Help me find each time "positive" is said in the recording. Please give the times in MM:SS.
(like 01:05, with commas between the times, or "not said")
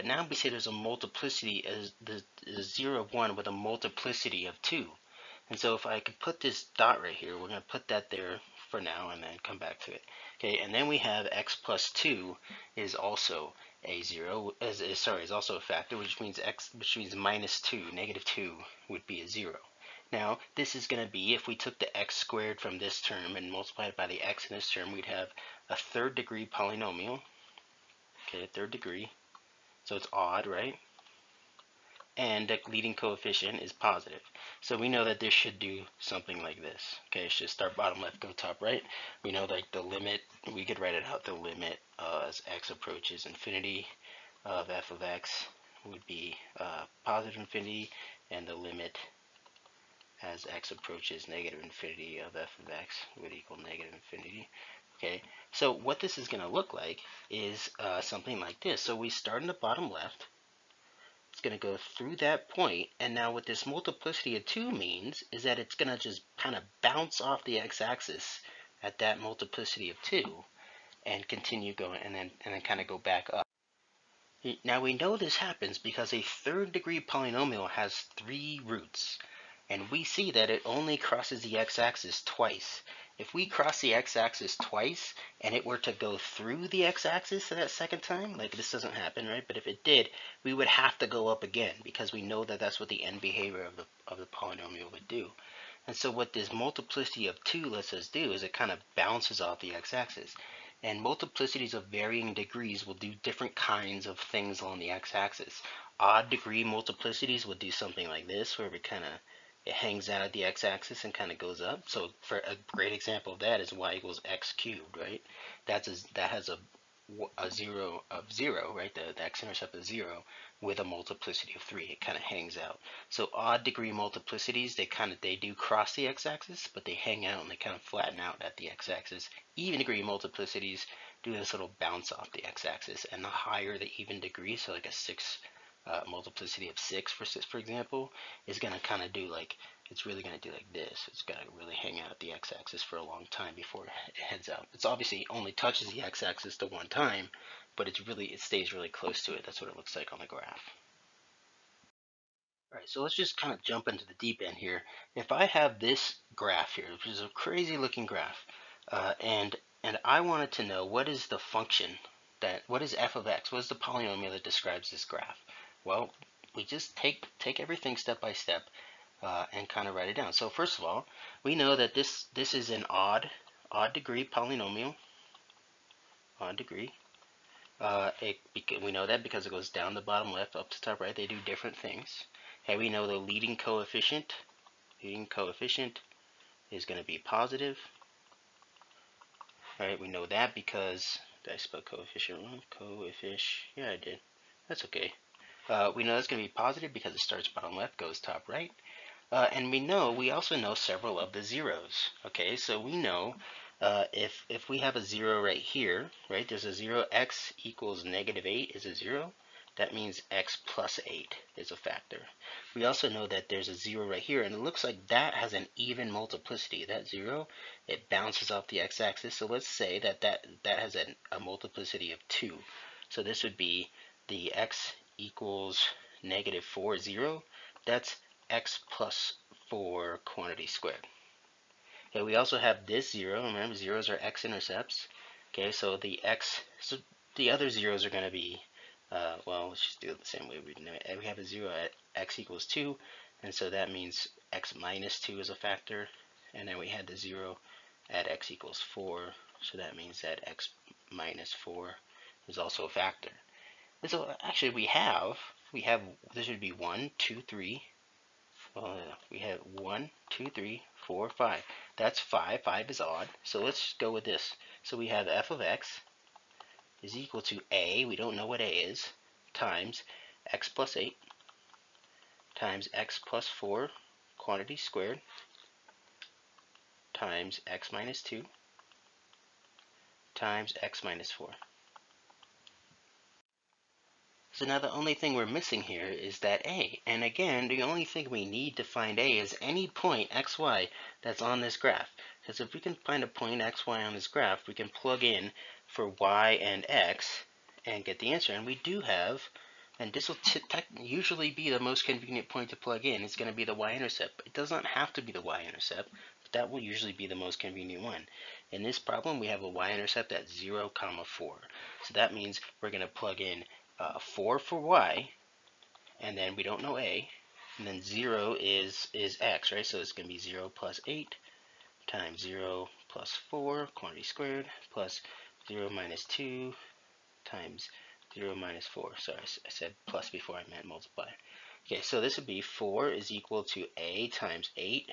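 00:33, 00:47, 03:07, 03:16.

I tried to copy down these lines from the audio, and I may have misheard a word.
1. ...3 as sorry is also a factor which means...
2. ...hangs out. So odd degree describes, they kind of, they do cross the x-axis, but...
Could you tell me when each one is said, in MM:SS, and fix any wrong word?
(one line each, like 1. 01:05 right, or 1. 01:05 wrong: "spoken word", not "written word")
1. 00:14 wrong: "0", not "3"
2. 02:02 wrong: "multiplicities", not "describes".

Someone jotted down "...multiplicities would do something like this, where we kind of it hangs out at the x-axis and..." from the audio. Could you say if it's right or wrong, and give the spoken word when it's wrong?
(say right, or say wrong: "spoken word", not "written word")
right.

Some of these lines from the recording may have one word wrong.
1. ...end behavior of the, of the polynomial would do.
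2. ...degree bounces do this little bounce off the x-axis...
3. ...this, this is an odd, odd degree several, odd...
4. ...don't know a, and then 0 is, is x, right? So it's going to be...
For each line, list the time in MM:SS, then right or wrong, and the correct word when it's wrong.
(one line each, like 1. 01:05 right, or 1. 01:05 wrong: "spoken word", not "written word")
1. 01:33 right
2. 02:09 wrong: "multiplicities", not "bounces"
3. 02:51 wrong: "polynomial", not "several"
4. 05:16 right.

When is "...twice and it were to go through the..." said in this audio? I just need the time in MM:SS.
01:24.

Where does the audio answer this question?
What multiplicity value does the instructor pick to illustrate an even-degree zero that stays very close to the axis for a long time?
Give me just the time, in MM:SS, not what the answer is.
02:16.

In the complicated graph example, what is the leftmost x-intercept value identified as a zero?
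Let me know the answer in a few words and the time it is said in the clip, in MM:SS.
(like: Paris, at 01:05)
-8, at 03:28.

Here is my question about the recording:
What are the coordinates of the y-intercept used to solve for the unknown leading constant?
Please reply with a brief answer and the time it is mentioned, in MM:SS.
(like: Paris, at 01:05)
(0, 4), at 05:10.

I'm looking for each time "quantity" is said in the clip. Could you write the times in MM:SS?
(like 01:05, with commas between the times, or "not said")
03:50, 04:34, 05:23.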